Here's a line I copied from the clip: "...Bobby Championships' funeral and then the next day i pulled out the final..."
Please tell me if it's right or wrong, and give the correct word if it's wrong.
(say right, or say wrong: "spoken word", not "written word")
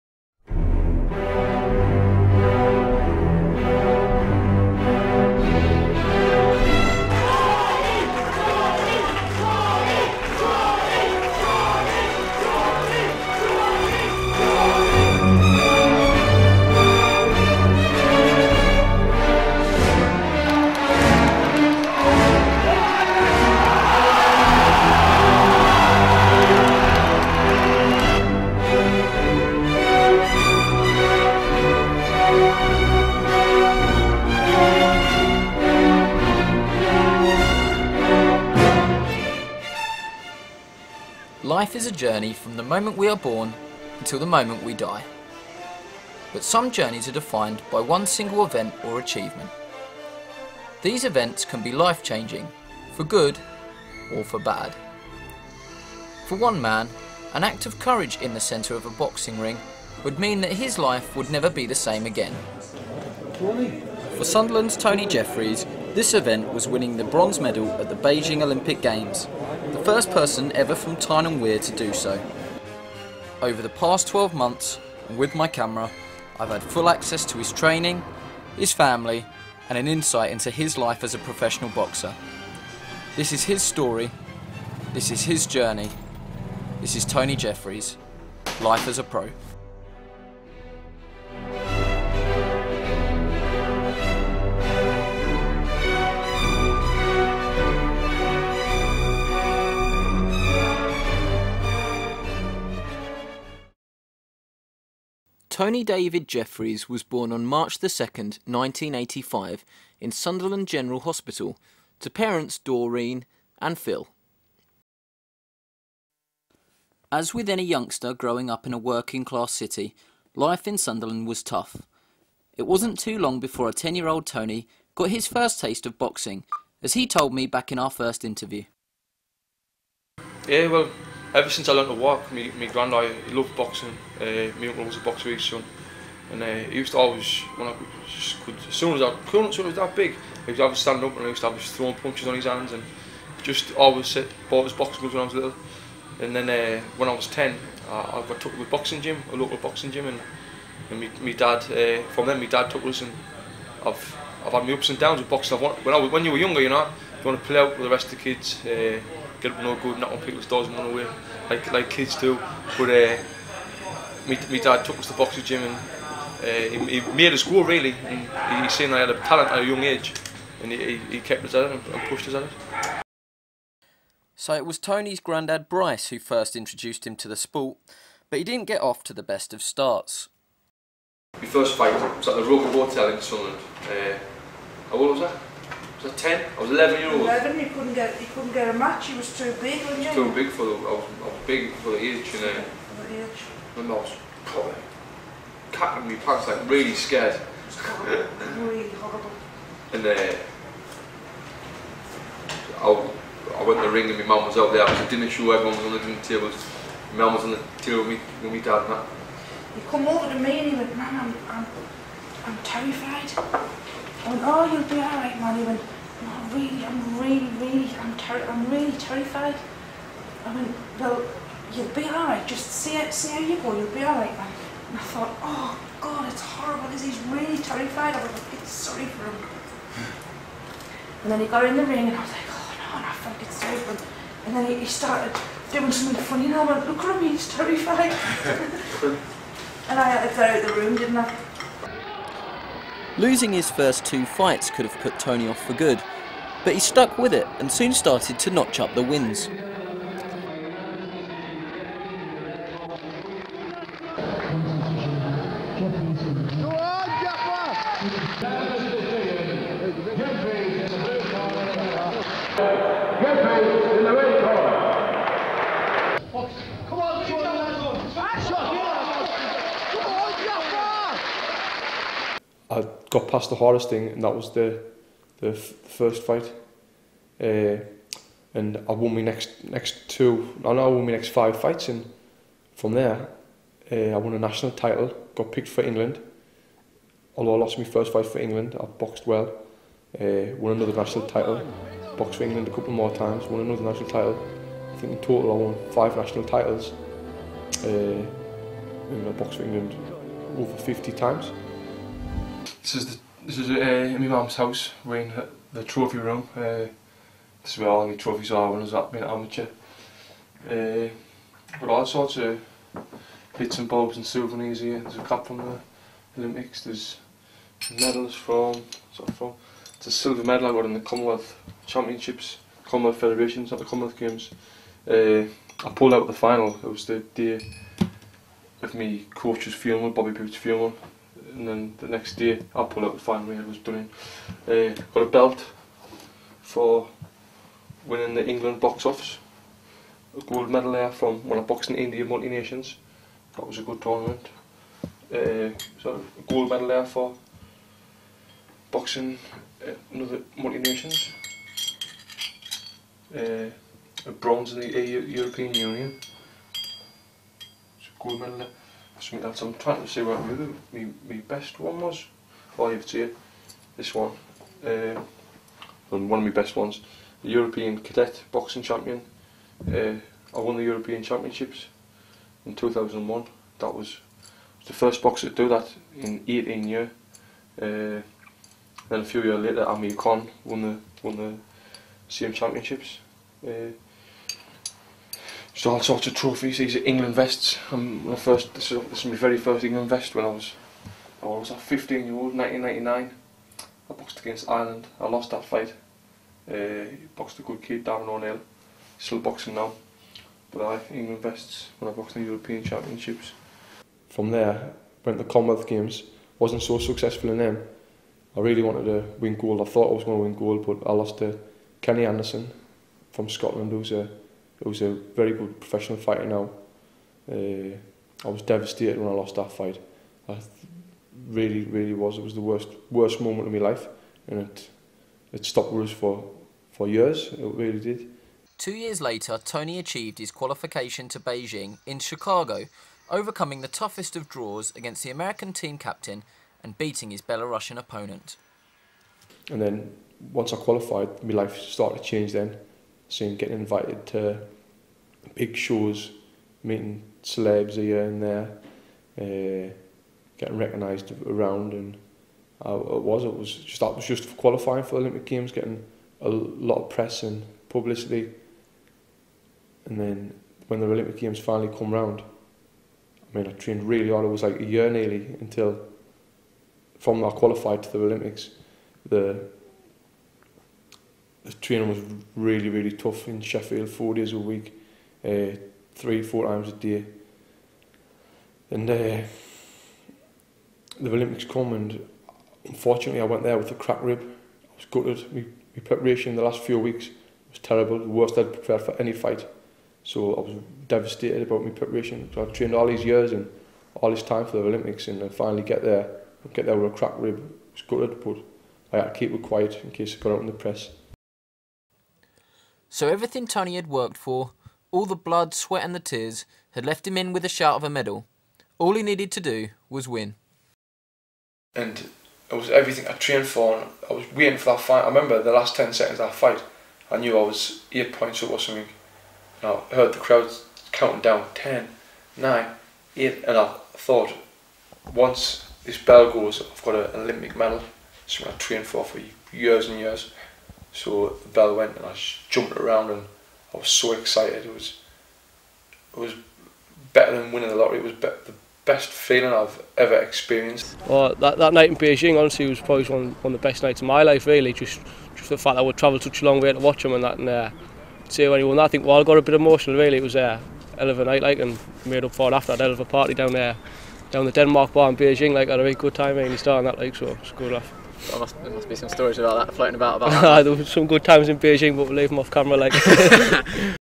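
wrong: "Boots", not "Championships".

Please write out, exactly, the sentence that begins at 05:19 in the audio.
It's a silver medal I got in the Commonwealth Championships, Commonwealth Federations, not the Commonwealth Games.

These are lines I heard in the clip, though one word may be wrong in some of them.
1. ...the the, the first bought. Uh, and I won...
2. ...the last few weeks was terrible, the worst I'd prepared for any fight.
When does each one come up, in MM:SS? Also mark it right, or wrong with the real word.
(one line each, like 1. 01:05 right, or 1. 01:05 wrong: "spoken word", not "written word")
1. 04:34 wrong: "fight", not "bought"
2. 08:06 right.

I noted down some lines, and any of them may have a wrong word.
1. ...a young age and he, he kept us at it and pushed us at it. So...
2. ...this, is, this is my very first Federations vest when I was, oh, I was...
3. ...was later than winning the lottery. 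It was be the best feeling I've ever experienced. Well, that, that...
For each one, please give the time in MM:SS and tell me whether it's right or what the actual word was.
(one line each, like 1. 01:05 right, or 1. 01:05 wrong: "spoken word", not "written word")
1. 02:49 right
2. 06:28 wrong: "England", not "Federations"
3. 08:56 wrong: "better", not "later".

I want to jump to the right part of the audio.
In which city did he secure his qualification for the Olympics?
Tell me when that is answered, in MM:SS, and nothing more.
07:12.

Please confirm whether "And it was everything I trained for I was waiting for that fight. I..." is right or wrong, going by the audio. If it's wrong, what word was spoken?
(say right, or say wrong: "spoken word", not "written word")
right.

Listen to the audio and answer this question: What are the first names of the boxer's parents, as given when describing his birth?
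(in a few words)
Doreen and Phil.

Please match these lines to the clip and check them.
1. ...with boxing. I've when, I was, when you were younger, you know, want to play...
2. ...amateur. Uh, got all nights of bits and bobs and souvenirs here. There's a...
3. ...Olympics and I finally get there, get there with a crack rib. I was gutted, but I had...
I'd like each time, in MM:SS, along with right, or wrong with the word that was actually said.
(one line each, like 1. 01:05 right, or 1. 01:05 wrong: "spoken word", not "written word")
1. 02:35 right
2. 05:09 wrong: "sorts", not "nights"
3. 08:14 right.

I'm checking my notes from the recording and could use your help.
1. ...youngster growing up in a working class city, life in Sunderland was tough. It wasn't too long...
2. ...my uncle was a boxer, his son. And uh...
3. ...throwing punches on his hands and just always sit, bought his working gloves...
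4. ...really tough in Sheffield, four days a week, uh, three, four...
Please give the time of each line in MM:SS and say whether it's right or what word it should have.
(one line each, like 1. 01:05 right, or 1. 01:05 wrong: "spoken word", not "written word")
1. 01:57 right
2. 02:14 right
3. 02:21 wrong: "boxing", not "working"
4. 07:52 right.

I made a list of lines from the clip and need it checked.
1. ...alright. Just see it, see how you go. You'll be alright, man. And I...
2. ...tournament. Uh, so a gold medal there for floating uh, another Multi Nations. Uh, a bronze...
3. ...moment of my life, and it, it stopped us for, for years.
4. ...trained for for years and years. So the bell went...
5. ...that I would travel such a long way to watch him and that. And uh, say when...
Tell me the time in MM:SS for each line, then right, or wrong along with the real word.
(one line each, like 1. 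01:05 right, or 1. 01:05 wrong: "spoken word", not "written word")
1. 03:42 right
2. 05:44 wrong: "boxing", not "floating"
3. 07:03 right
4. 08:48 right
5. 09:05 right.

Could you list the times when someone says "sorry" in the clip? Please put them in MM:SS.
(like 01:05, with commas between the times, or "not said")
03:48, 03:53.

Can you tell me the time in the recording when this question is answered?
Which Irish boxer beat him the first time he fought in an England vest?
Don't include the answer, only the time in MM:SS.
06:38.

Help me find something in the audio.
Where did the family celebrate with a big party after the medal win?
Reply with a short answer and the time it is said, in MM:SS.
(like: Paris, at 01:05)
the Denmark bar, at 09:14.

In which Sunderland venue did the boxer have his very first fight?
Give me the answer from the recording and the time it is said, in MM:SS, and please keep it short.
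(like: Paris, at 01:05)
Roker Hotel, at 03:02.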